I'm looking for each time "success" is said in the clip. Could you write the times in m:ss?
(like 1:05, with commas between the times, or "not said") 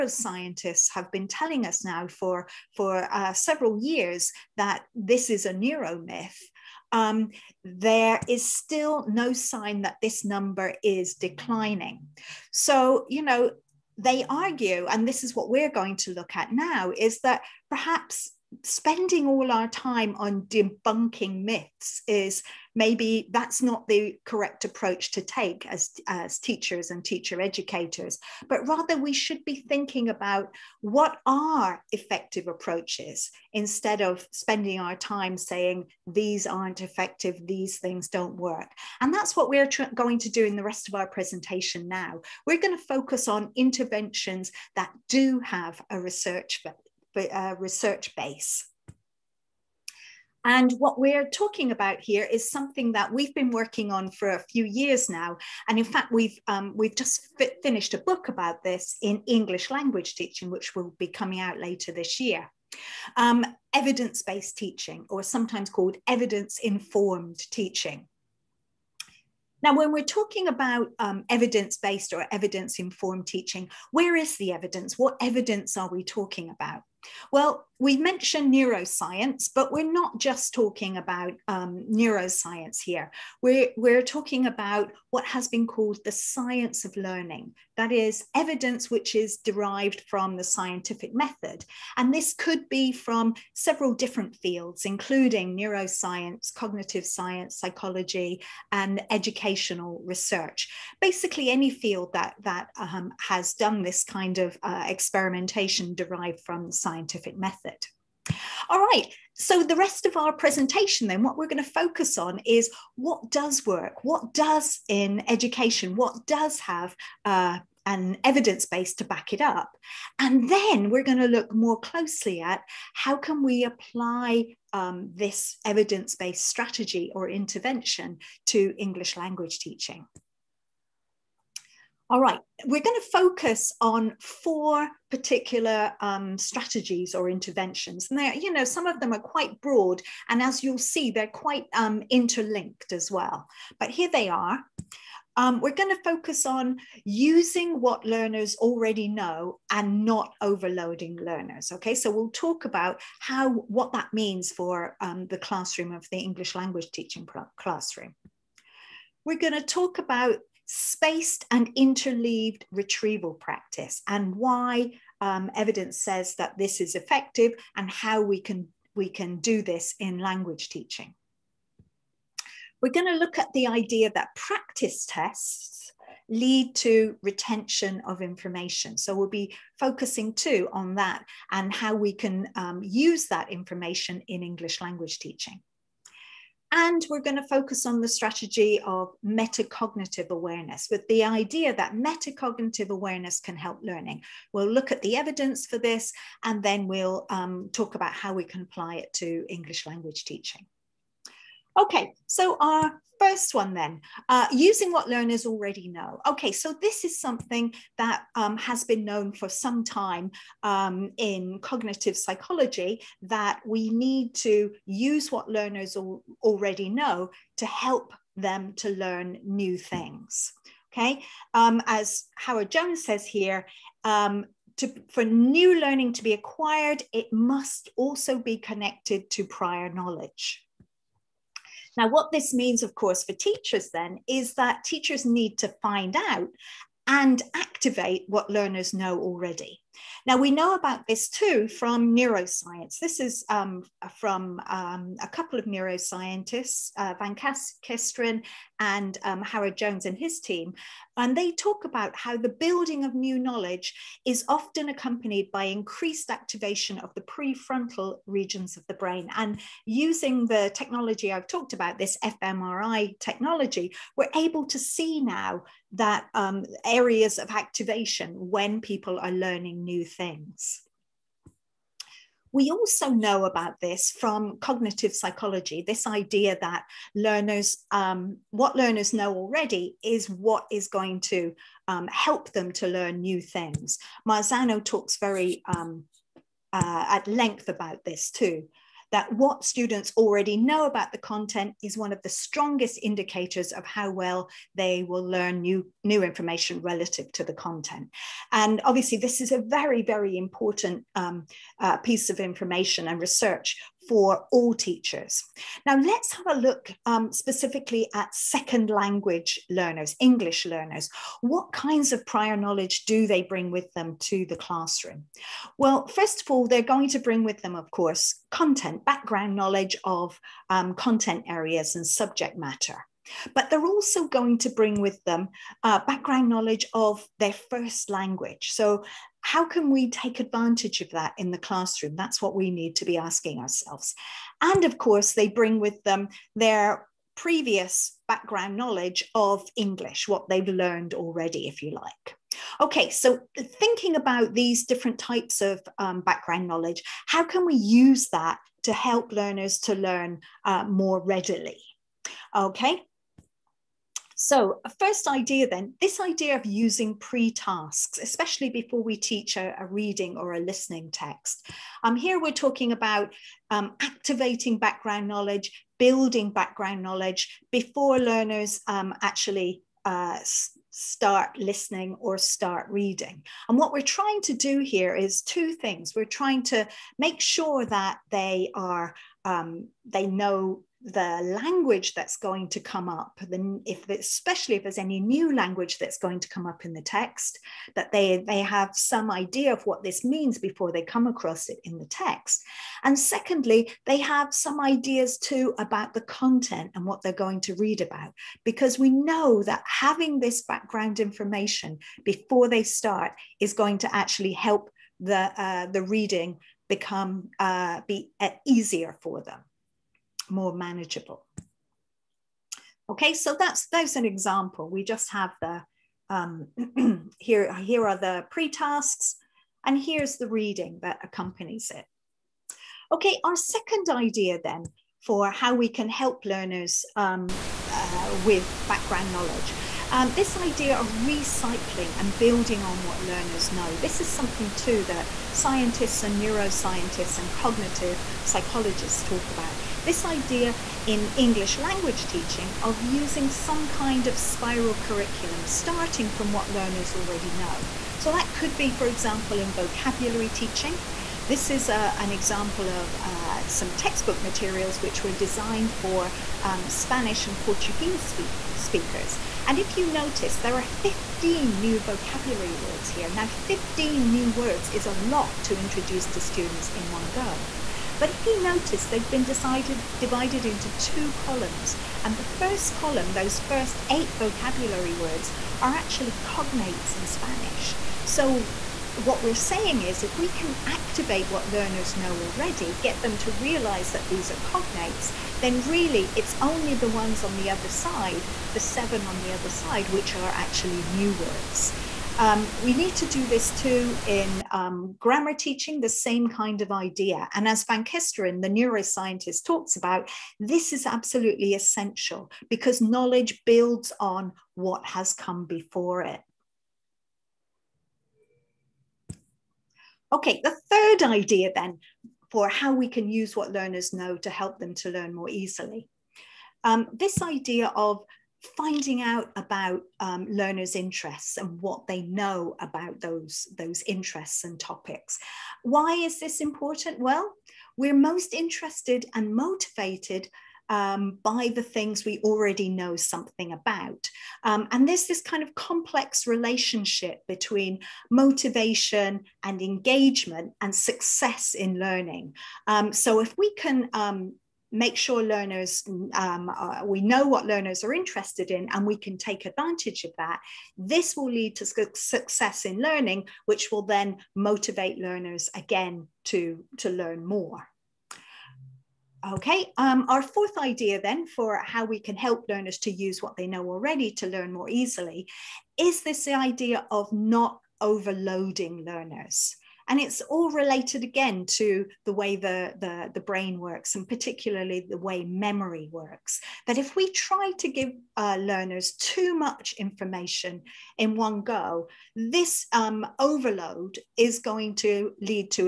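9:00, 9:12.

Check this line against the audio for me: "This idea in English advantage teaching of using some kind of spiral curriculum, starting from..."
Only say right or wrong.
wrong.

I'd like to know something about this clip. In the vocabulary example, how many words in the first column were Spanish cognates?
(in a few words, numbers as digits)
8.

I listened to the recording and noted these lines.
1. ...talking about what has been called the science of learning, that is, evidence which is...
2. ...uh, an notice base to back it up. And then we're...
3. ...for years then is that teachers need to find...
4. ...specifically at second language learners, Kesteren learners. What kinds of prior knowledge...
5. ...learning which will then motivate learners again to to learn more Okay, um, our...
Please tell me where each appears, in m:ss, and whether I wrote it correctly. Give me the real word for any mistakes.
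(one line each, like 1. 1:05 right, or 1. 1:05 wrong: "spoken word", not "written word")
1. 1:24 right
2. 1:57 wrong: "evidence", not "notice"
3. 3:53 wrong: "teachers", not "years"
4. 5:07 wrong: "English", not "Kesteren"
5. 9:13 right.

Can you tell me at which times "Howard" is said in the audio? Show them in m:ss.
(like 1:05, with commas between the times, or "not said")
3:42, 4:09.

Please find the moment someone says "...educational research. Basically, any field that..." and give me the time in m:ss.
1:39.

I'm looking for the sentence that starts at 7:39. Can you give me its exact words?
And if you notice, there are 15 new vocabulary words here.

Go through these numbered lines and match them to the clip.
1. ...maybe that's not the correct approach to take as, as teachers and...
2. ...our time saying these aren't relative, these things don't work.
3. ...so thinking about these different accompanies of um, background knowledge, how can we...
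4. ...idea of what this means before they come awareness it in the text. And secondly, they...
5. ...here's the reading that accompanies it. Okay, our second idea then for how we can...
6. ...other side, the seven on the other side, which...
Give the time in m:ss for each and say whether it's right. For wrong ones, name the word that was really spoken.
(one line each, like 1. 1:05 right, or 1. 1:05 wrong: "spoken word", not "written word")
1. 0:22 right
2. 0:34 wrong: "effective", not "relative"
3. 5:43 wrong: "types", not "accompanies"
4. 6:29 wrong: "across", not "awareness"
5. 7:00 right
6. 8:07 right.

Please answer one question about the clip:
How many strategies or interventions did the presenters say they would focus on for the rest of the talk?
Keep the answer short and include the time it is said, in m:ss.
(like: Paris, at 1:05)
4, at 2:14.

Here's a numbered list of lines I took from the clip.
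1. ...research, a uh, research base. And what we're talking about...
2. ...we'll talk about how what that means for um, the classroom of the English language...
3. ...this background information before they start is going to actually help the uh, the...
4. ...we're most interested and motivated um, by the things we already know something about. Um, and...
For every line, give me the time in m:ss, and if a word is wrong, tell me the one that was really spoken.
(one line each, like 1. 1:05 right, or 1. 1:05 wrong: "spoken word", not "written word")
1. 0:45 right
2. 2:32 right
3. 6:40 right
4. 8:47 right.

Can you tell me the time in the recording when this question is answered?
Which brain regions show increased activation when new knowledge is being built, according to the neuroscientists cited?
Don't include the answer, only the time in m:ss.
4:17.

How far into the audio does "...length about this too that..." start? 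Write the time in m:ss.
4:47.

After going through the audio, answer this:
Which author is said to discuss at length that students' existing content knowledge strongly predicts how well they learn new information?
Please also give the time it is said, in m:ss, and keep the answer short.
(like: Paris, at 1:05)
Marzano, at 4:44.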